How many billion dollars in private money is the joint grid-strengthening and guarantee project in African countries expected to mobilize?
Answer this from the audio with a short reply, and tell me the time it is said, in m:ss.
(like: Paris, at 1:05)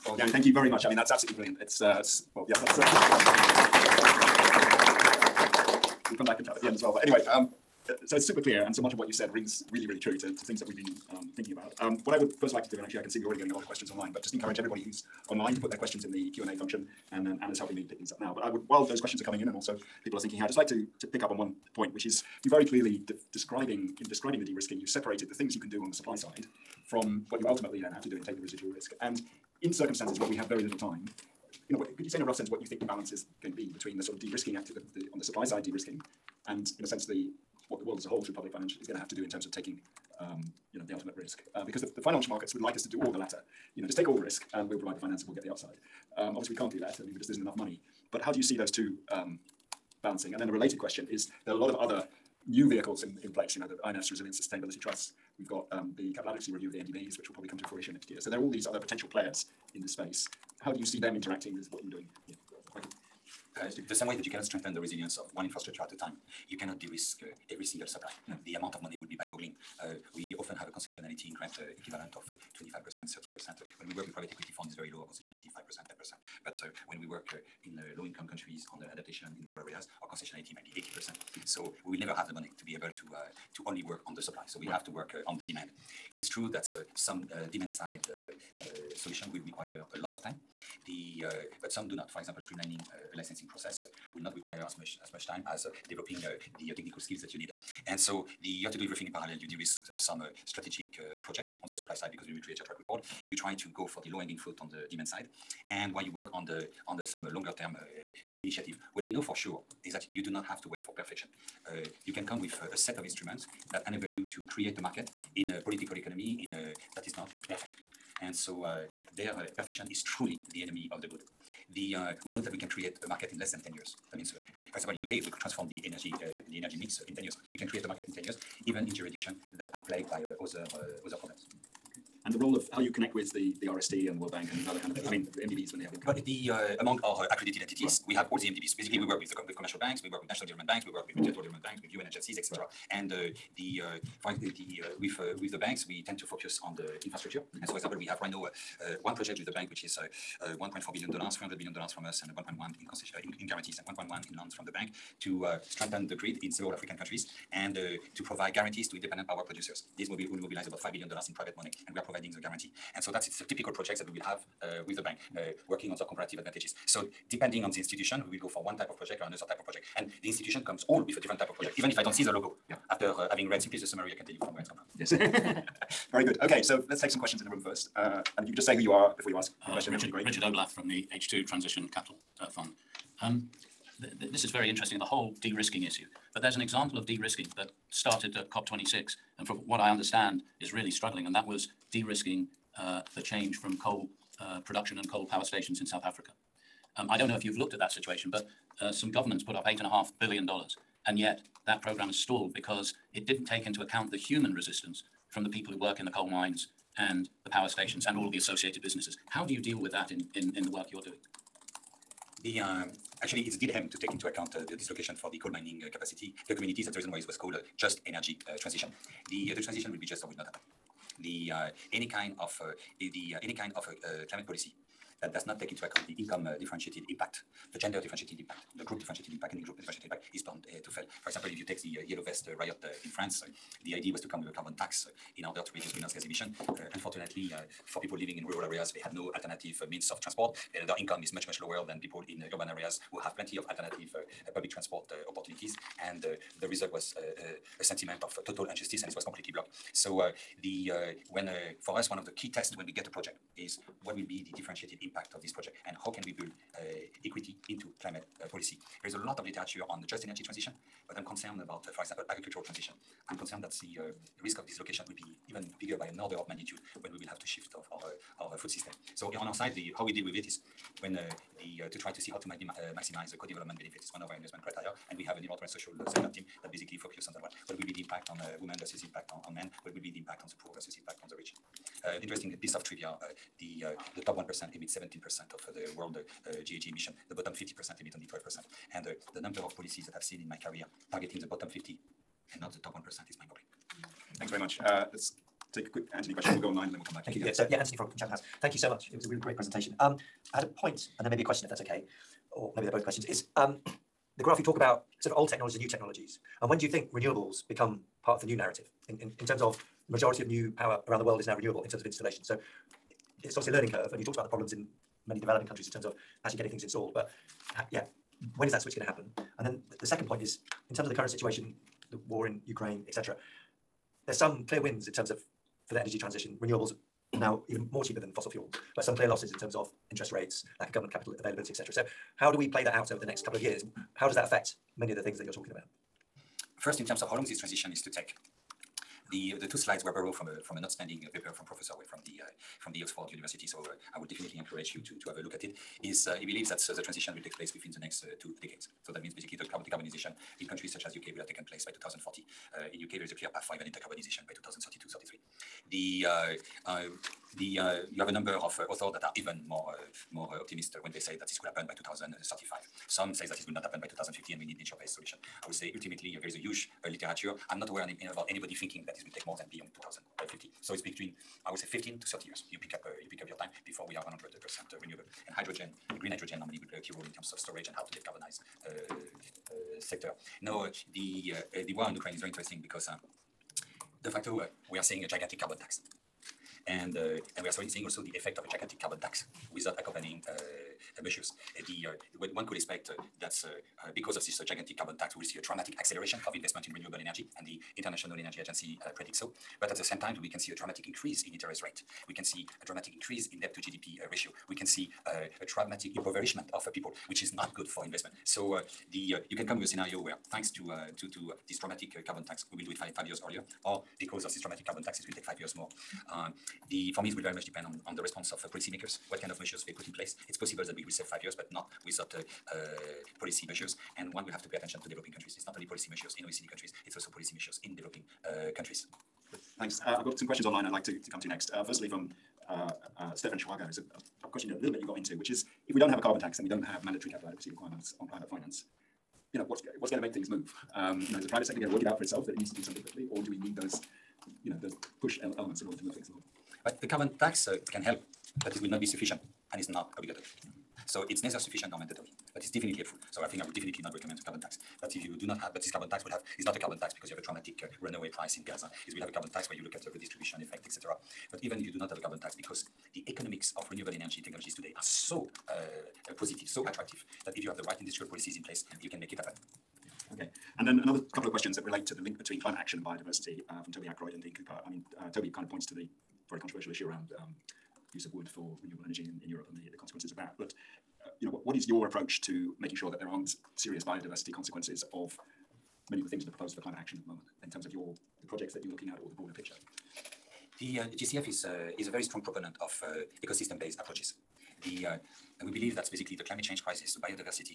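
$5 billion, at 2:40.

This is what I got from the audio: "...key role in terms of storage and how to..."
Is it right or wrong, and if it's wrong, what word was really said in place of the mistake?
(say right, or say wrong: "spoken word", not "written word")
right.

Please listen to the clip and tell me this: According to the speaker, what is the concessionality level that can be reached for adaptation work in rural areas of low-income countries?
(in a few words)
80%.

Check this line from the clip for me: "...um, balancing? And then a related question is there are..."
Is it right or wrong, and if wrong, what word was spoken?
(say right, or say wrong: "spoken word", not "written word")
right.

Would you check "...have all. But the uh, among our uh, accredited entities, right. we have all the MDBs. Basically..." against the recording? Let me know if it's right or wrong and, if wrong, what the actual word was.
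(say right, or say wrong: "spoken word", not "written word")
right.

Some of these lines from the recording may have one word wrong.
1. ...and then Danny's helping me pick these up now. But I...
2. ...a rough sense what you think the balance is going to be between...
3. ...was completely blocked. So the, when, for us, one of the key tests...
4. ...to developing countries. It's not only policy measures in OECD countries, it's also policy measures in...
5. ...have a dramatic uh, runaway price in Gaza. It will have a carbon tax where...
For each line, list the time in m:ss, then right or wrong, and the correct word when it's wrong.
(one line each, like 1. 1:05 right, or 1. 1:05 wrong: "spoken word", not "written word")
1. 0:17 wrong: "Anna", not "Danny"
2. 0:32 right
3. 4:09 right
4. 7:05 right
5. 7:37 right.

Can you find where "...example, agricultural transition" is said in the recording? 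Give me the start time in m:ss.
4:22.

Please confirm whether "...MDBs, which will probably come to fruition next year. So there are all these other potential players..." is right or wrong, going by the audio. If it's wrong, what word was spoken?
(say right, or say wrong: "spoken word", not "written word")
right.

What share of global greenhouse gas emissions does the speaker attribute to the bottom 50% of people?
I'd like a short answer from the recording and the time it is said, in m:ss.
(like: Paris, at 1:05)
12%, at 4:48.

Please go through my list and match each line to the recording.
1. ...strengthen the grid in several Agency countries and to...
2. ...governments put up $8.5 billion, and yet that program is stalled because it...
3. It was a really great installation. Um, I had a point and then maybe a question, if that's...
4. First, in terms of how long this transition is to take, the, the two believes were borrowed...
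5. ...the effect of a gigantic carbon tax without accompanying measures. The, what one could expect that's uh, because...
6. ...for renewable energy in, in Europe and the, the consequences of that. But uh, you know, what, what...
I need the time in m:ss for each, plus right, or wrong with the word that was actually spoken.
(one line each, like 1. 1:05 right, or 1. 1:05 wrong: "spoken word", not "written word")
1. 2:35 wrong: "African", not "Agency"
2. 3:19 right
3. 4:59 wrong: "presentation", not "installation"
4. 5:36 wrong: "slides", not "believes"
5. 6:28 right
6. 7:58 right.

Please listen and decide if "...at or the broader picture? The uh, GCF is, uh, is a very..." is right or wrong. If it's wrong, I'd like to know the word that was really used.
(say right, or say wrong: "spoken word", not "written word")
right.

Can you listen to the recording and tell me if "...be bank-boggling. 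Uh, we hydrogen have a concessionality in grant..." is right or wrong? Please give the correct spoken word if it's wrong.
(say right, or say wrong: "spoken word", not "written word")
wrong: "often", not "hydrogen".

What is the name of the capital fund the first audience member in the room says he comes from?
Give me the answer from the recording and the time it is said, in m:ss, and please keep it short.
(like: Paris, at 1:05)
H2 Transition Capital Fund, at 3:01.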